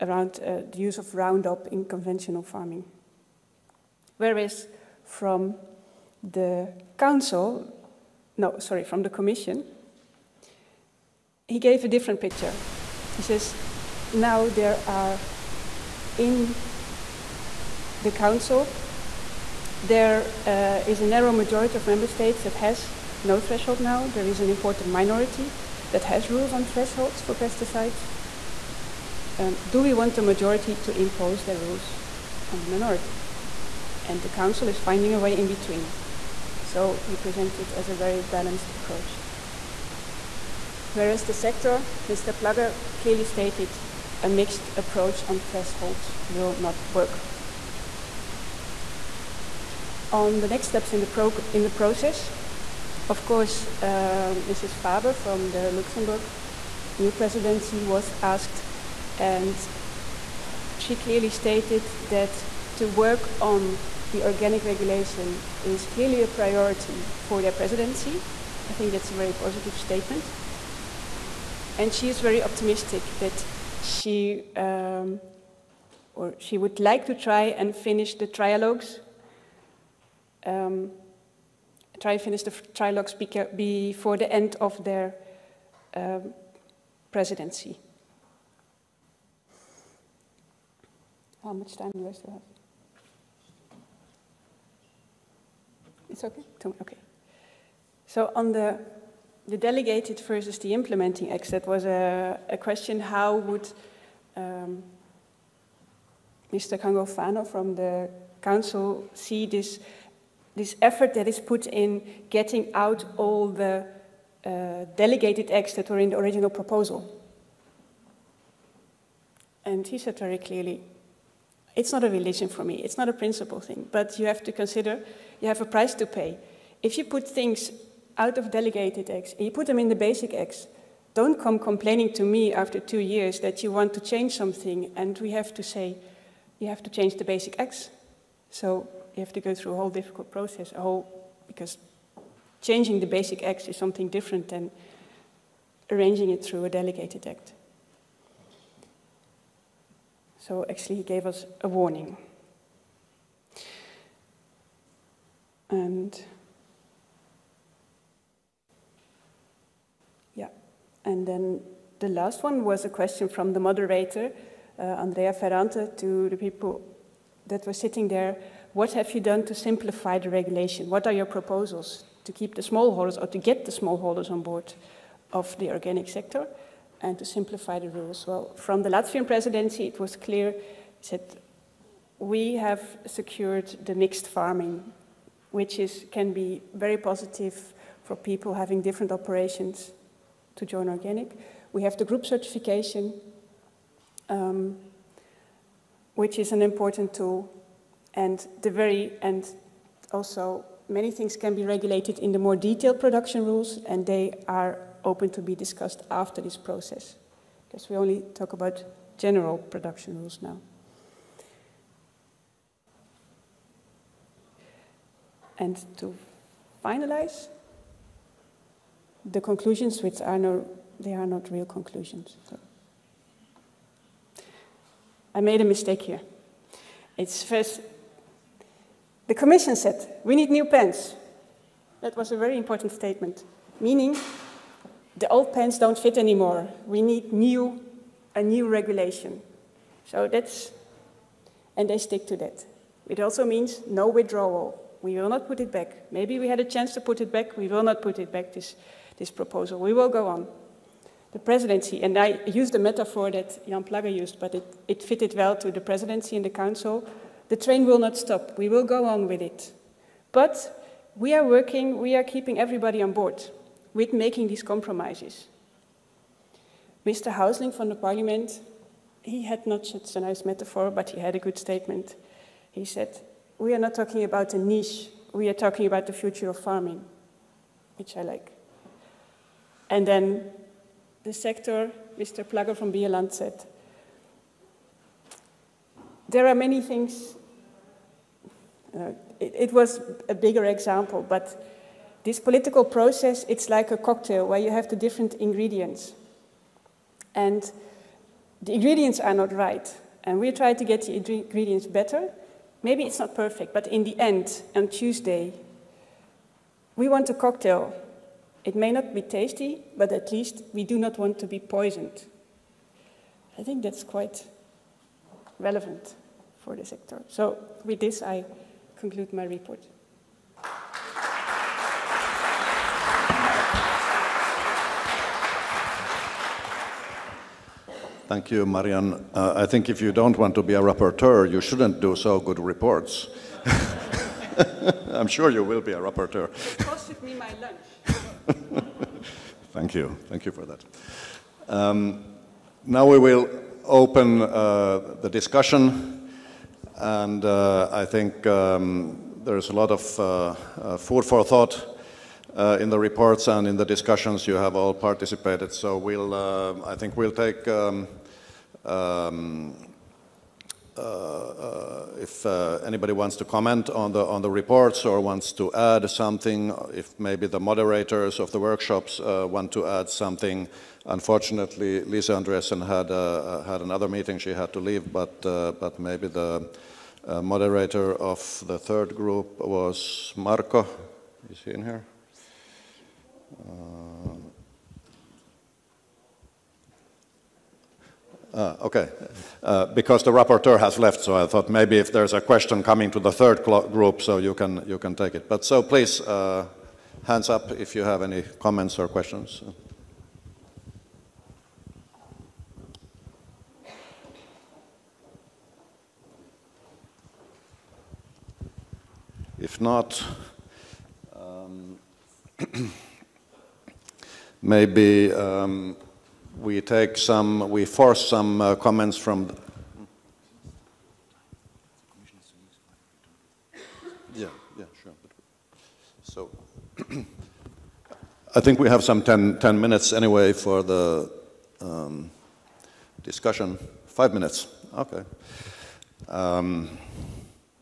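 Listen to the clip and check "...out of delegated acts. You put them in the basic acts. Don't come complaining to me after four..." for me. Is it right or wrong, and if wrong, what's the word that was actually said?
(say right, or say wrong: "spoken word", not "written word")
wrong: "two", not "four".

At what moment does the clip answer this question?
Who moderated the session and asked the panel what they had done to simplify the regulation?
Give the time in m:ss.
2:44.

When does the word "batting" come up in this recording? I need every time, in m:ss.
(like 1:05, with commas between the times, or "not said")
not said.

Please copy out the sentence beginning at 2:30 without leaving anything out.
So actually, he gave us a warning.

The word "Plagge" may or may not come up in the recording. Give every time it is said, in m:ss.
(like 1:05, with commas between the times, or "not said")
0:42, 4:13, 4:42.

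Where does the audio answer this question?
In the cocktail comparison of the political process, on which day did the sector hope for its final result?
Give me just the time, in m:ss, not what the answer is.
5:04.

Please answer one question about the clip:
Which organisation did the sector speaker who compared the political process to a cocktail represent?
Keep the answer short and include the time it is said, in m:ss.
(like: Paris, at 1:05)
Bioland, at 4:42.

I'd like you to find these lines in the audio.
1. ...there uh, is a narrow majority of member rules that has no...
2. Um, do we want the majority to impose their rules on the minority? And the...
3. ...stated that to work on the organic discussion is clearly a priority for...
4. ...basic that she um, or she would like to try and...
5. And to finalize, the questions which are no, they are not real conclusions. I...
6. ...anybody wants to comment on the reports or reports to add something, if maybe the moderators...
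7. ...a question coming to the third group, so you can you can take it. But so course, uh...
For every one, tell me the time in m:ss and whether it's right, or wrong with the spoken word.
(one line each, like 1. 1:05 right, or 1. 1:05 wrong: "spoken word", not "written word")
1. 0:19 wrong: "states", not "rules"
2. 0:29 right
3. 1:01 wrong: "regulation", not "discussion"
4. 1:12 wrong: "optimistic", not "basic"
5. 3:35 wrong: "conclusions", not "questions"
6. 6:02 wrong: "wants", not "reports"
7. 6:32 wrong: "please", not "course".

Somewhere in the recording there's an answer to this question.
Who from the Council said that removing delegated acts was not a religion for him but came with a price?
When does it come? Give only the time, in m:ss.
1:46.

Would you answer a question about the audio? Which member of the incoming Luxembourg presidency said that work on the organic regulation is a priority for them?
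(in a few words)
Mrs. Faber.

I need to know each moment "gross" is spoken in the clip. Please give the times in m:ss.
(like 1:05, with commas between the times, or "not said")
not said.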